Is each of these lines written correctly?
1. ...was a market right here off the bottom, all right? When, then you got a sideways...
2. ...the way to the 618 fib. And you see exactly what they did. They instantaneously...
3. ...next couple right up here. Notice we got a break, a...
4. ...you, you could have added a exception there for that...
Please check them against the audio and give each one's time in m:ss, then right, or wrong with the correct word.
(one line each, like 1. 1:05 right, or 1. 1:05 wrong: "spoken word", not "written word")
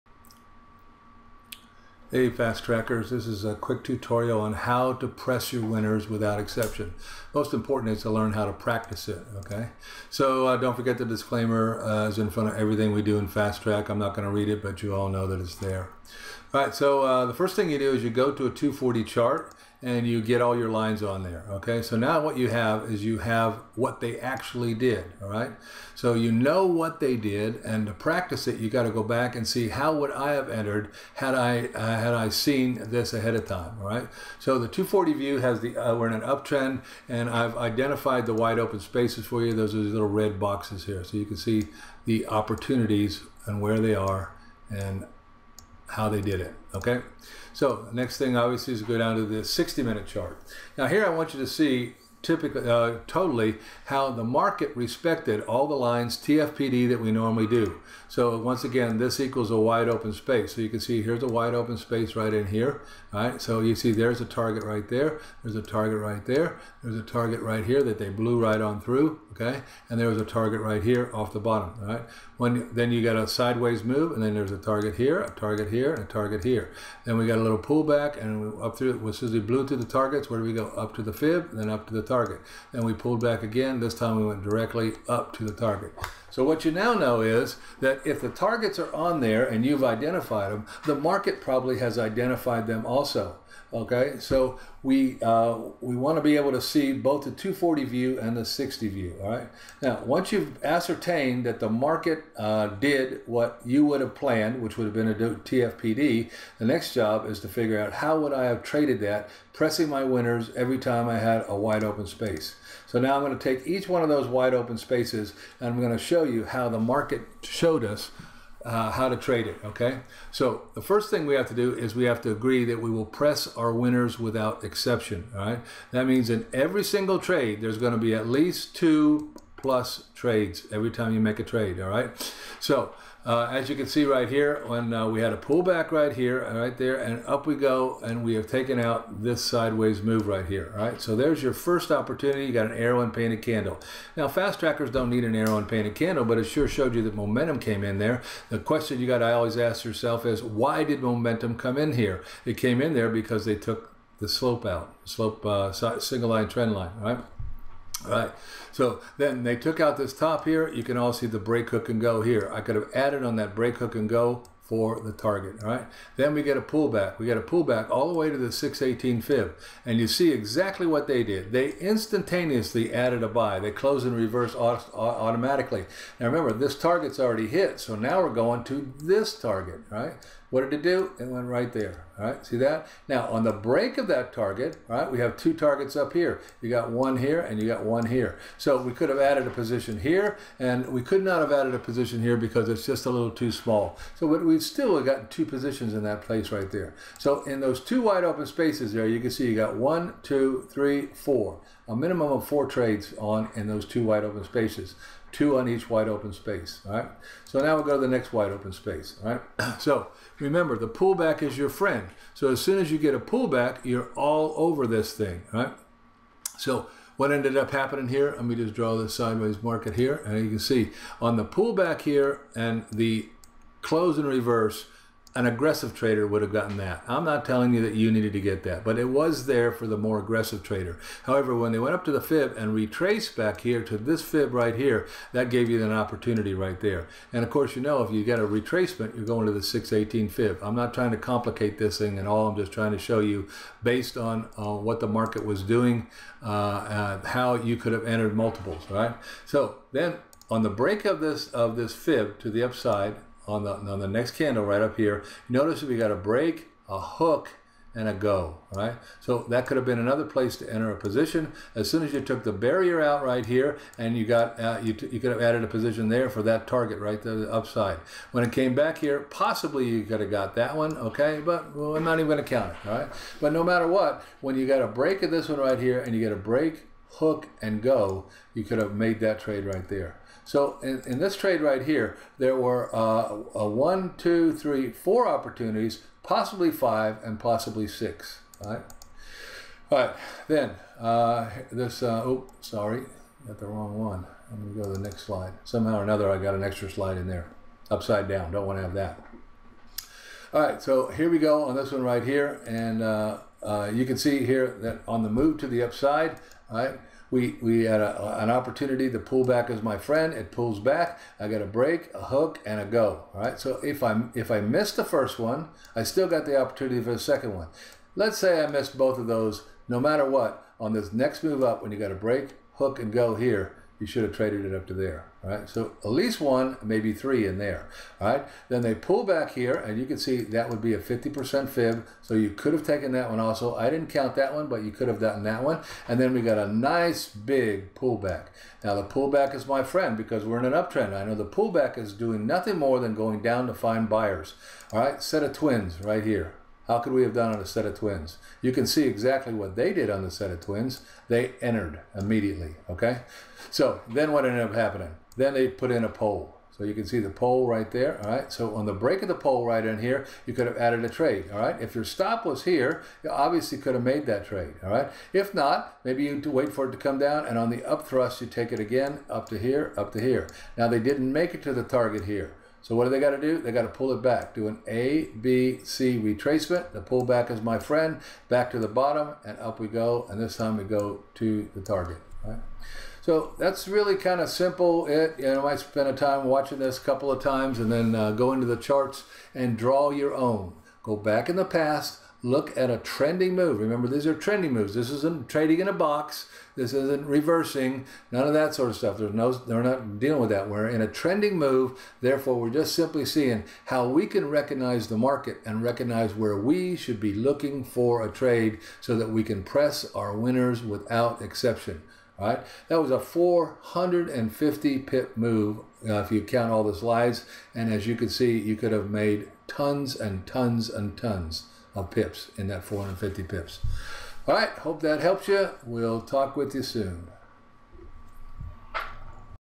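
1. 1:10 wrong: "target", not "market"
2. 2:48 right
3. 4:14 wrong: "candle", not "couple"
4. 4:24 wrong: "position", not "exception".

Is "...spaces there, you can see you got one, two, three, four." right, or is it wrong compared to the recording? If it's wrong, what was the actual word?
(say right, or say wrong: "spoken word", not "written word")
right.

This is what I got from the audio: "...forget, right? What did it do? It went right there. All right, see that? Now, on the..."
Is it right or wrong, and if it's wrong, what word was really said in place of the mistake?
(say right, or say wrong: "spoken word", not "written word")
wrong: "target", not "forget".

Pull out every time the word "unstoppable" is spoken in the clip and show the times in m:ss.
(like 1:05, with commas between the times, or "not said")
not said.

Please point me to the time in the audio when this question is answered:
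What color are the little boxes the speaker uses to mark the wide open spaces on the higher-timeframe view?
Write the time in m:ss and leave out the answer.
0:40.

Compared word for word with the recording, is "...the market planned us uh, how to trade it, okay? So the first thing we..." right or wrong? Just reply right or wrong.
wrong.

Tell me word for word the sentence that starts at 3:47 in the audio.
I'm not telling you that you needed to get that, but it was there for the more aggressive trader.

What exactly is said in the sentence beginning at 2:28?
The question you got I always ask yourself is, why did momentum come in here?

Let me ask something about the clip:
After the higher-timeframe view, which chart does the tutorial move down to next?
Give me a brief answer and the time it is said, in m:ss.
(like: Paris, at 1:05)
60 minute chart, at 0:49.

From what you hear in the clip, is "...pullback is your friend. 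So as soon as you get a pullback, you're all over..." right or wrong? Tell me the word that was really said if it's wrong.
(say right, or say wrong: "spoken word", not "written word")
right.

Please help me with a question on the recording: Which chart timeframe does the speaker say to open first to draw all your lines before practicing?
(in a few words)
240 chart.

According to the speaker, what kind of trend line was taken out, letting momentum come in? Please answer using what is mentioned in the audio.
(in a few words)
Single line trend line.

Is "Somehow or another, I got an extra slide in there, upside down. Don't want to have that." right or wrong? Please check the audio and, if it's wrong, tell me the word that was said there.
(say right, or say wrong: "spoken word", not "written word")
right.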